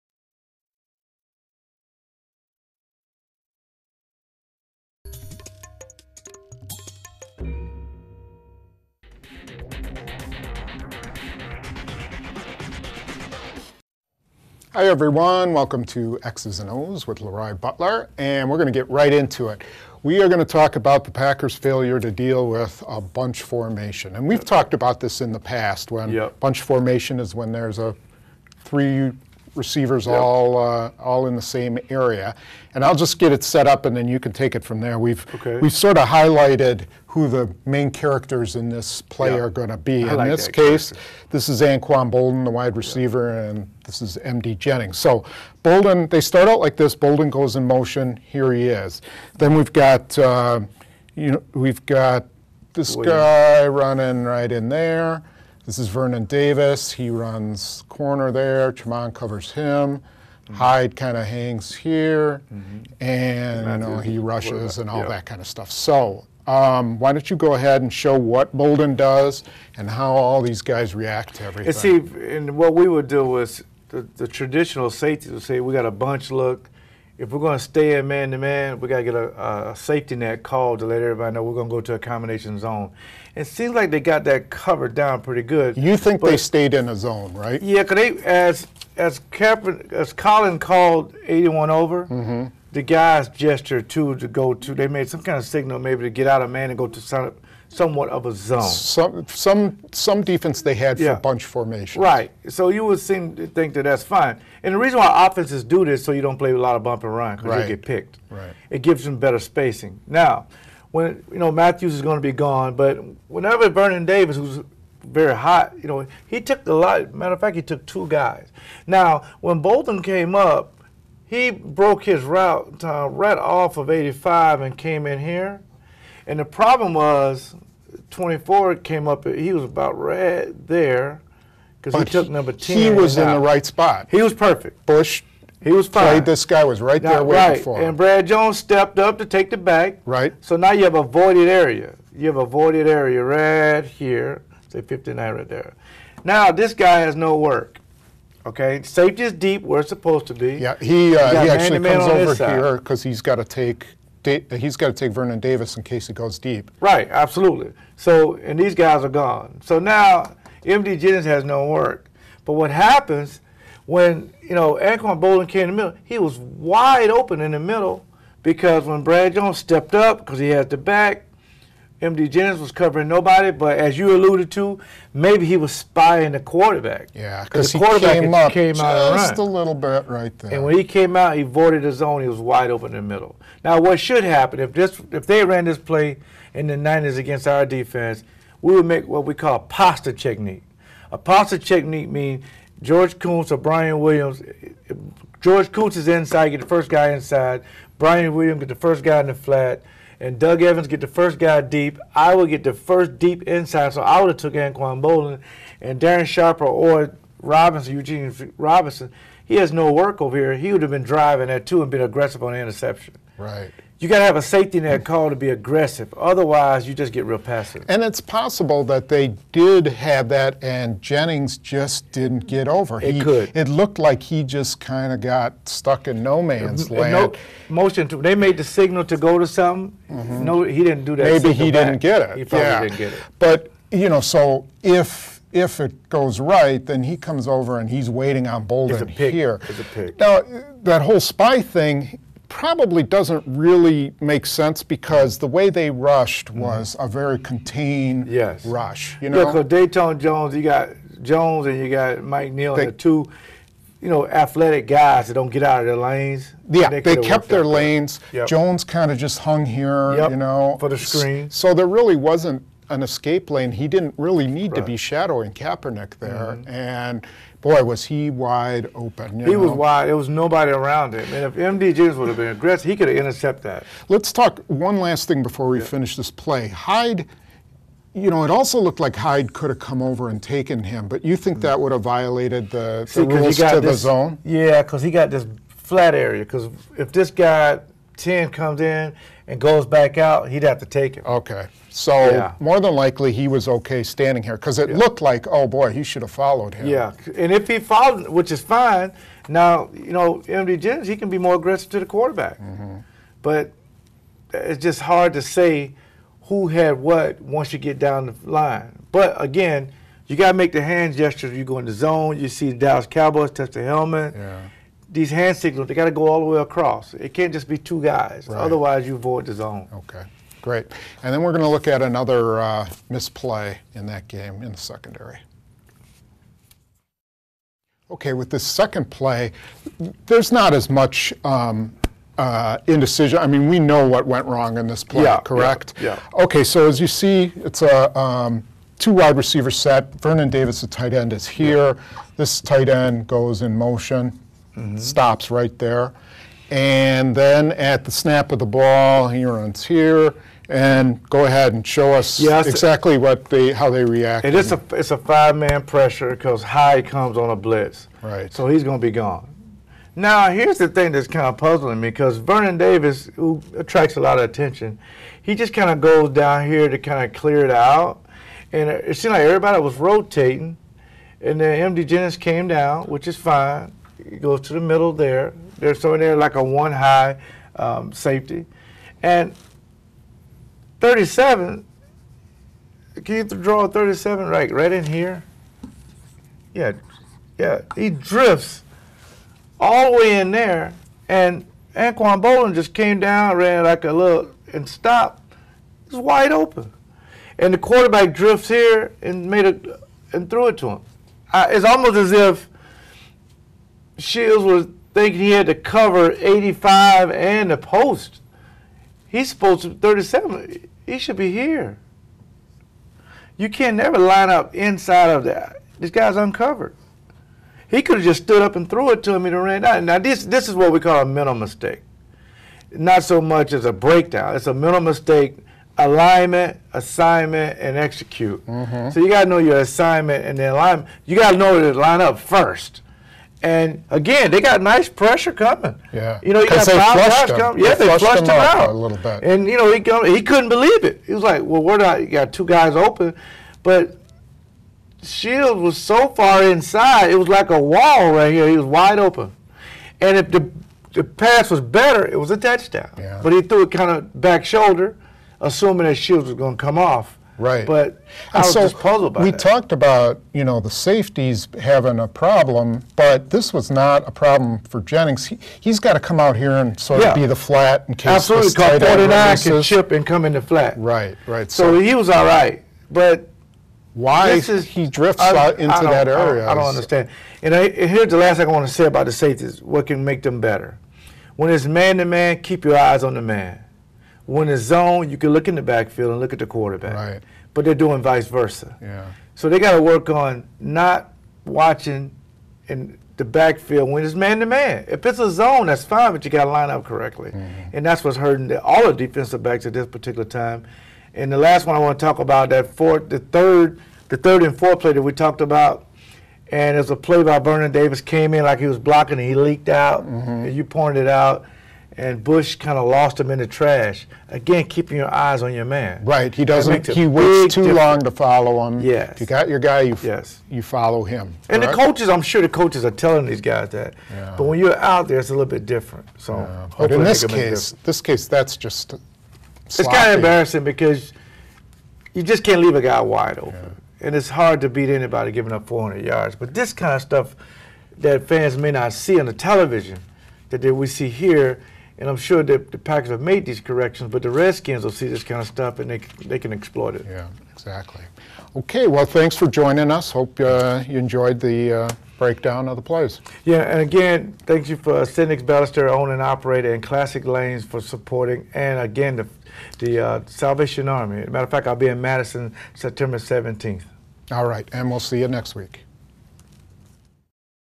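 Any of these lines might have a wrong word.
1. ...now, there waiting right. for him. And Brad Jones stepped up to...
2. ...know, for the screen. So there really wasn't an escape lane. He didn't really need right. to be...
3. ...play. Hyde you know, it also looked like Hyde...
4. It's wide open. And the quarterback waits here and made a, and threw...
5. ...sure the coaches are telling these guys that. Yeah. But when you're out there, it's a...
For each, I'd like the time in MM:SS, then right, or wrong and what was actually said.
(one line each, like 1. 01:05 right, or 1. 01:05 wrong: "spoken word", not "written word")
1. 02:17 right
2. 04:20 right
3. 04:36 right
4. 06:36 wrong: "drifts", not "waits"
5. 08:42 right.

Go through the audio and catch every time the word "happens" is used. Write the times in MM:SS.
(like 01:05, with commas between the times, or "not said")
02:42, 03:04.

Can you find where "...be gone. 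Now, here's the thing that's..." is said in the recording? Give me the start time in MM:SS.
05:59.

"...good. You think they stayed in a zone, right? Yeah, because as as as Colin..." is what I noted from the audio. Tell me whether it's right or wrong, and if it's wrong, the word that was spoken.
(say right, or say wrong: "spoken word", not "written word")
right.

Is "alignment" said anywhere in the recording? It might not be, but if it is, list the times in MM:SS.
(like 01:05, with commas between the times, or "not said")
07:05, 07:10.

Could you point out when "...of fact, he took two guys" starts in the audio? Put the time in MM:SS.
01:57.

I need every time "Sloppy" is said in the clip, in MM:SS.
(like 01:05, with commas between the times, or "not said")
08:49.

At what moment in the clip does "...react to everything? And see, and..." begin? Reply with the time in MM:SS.
01:10.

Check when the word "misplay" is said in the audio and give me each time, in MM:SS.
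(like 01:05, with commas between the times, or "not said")
05:23.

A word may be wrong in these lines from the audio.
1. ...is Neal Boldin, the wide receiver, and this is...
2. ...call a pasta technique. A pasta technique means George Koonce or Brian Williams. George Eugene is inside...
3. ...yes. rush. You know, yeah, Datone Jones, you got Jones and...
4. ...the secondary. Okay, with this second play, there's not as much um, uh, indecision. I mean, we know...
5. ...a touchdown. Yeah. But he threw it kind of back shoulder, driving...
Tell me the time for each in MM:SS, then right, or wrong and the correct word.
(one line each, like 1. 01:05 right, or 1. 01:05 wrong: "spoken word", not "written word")
1. 00:41 wrong: "Anquan", not "Neal"
2. 03:09 wrong: "Koonce", not "Eugene"
3. 04:08 right
4. 05:24 right
5. 07:32 wrong: "assuming", not "driving".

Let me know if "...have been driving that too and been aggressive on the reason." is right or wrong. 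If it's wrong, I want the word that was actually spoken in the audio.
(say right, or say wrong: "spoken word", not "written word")
wrong: "interception", not "reason".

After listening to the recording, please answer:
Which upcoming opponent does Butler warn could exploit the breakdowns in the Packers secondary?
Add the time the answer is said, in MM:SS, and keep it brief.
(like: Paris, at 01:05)
Redskins, at 09:04.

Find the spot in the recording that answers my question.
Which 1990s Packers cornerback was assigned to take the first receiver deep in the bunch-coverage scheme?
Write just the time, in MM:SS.
03:20.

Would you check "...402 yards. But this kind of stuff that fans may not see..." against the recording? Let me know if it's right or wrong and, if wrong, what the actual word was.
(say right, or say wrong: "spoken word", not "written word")
wrong: "400", not "402".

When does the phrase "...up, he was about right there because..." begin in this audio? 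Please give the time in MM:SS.
02:09.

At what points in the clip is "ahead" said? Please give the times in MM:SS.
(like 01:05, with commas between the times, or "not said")
01:07, 05:51.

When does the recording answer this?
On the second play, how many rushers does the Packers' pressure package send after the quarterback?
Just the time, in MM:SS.
05:55.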